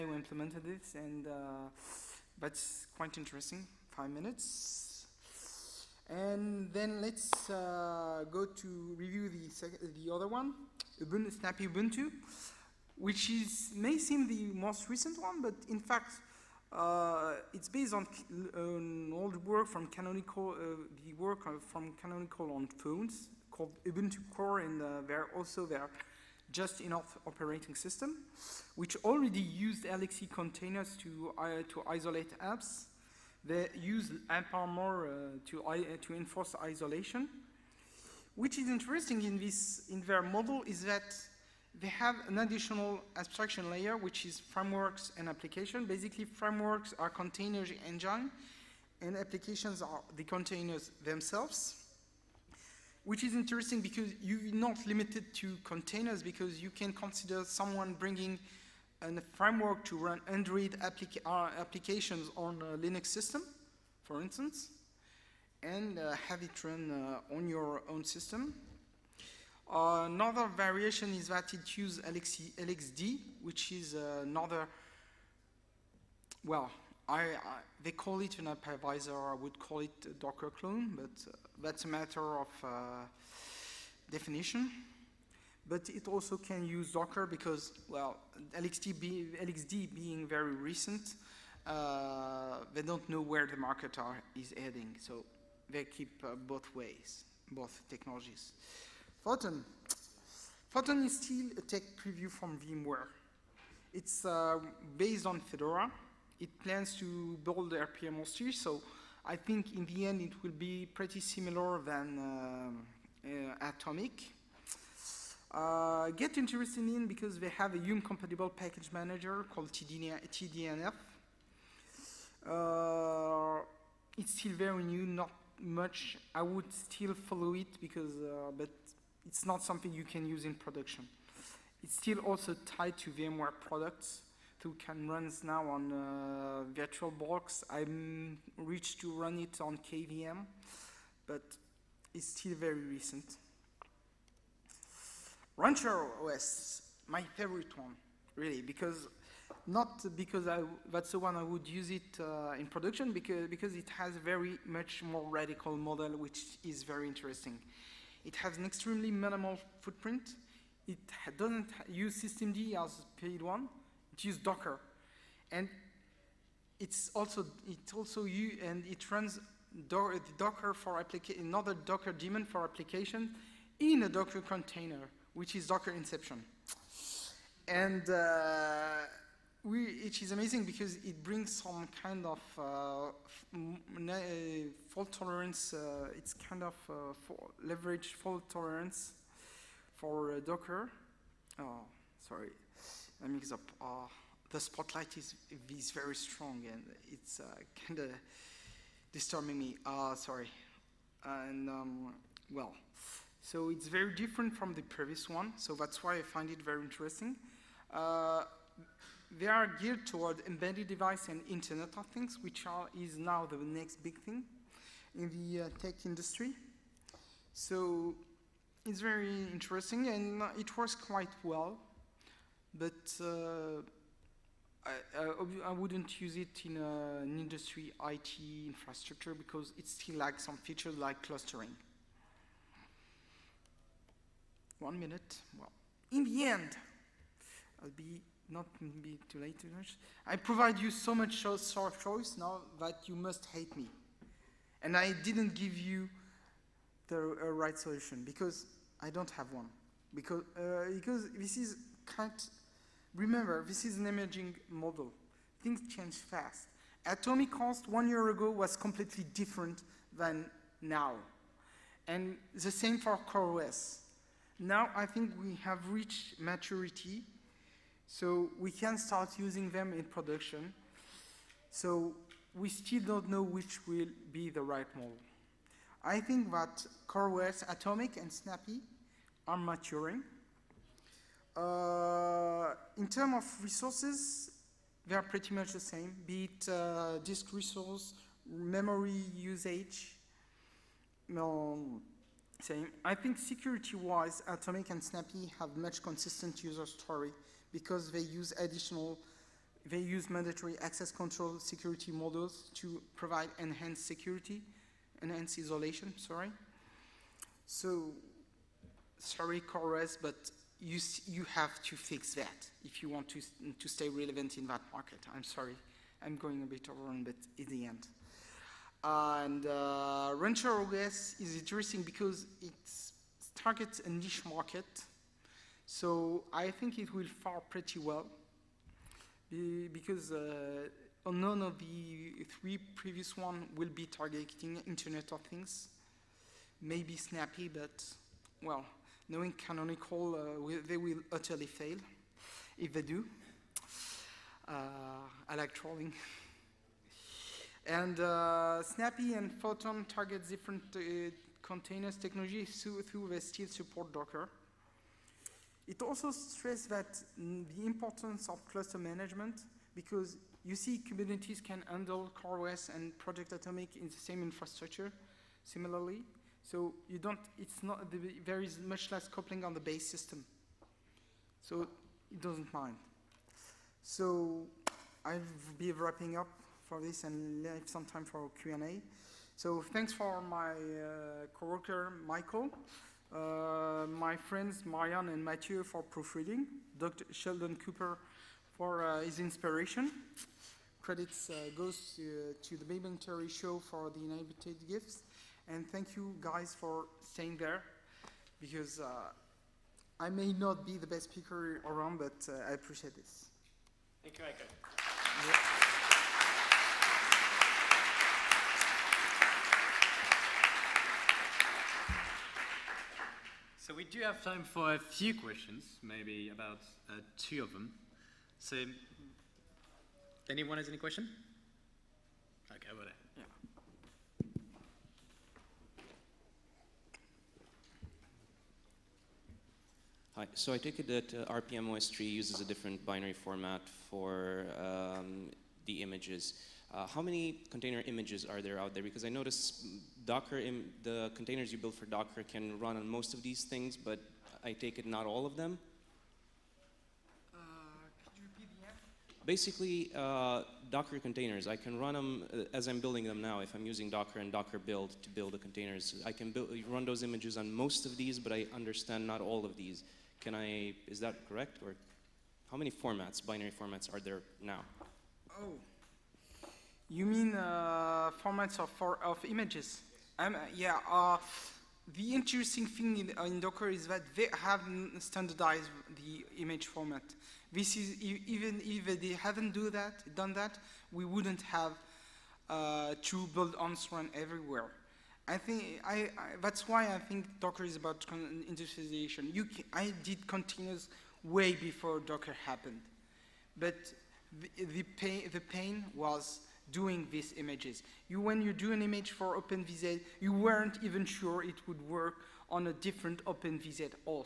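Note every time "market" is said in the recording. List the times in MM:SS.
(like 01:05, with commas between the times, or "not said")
01:33, 05:14, 05:24.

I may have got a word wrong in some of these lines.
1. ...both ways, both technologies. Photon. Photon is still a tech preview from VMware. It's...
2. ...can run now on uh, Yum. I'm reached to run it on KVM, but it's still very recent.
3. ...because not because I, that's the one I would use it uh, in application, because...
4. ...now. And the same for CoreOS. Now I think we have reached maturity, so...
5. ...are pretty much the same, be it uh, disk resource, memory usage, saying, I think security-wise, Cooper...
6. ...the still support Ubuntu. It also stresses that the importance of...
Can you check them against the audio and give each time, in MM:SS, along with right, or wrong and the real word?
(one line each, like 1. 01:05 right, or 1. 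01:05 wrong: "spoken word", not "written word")
1. 01:36 right
2. 02:14 wrong: "VirtualBox", not "Yum"
3. 02:28 wrong: "production", not "application"
4. 04:20 right
5. 04:45 wrong: "Atomic", not "Cooper"
6. 05:53 wrong: "Docker", not "Ubuntu".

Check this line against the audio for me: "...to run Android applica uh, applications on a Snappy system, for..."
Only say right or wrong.
wrong.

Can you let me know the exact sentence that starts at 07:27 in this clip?
Uh, Basically, uh, Docker containers, I can run them uh, as I'm building them now.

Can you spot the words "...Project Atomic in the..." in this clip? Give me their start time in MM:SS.
06:03.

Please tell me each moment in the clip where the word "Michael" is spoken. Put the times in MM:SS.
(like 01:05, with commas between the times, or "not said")
06:22, 06:44.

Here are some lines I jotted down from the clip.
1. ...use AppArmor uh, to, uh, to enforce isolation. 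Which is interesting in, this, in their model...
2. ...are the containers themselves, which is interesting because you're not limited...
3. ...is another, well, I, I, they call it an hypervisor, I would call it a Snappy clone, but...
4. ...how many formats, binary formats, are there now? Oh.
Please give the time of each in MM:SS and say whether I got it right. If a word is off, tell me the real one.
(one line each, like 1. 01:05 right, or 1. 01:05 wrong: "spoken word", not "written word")
1. 00:33 right
2. 00:49 right
3. 01:13 wrong: "Docker", not "Snappy"
4. 07:42 right.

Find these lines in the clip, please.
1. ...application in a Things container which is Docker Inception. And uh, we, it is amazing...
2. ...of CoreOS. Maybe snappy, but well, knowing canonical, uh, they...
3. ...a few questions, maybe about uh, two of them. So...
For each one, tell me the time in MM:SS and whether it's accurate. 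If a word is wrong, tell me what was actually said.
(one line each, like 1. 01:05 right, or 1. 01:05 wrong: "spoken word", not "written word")
1. 02:52 wrong: "Docker", not "Things"
2. 05:35 wrong: "Things", not "CoreOS"
3. 06:54 right.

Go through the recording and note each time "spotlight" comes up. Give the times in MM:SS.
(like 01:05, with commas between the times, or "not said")
03:14.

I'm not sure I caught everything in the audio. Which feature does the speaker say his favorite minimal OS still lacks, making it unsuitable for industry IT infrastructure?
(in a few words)
Clustering.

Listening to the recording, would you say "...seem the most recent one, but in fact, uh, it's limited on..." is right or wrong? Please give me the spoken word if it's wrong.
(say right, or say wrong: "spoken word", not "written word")
wrong: "based", not "limited".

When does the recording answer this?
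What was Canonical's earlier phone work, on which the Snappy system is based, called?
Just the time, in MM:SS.
00:23.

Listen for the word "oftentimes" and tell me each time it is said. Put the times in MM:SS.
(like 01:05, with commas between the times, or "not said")
not said.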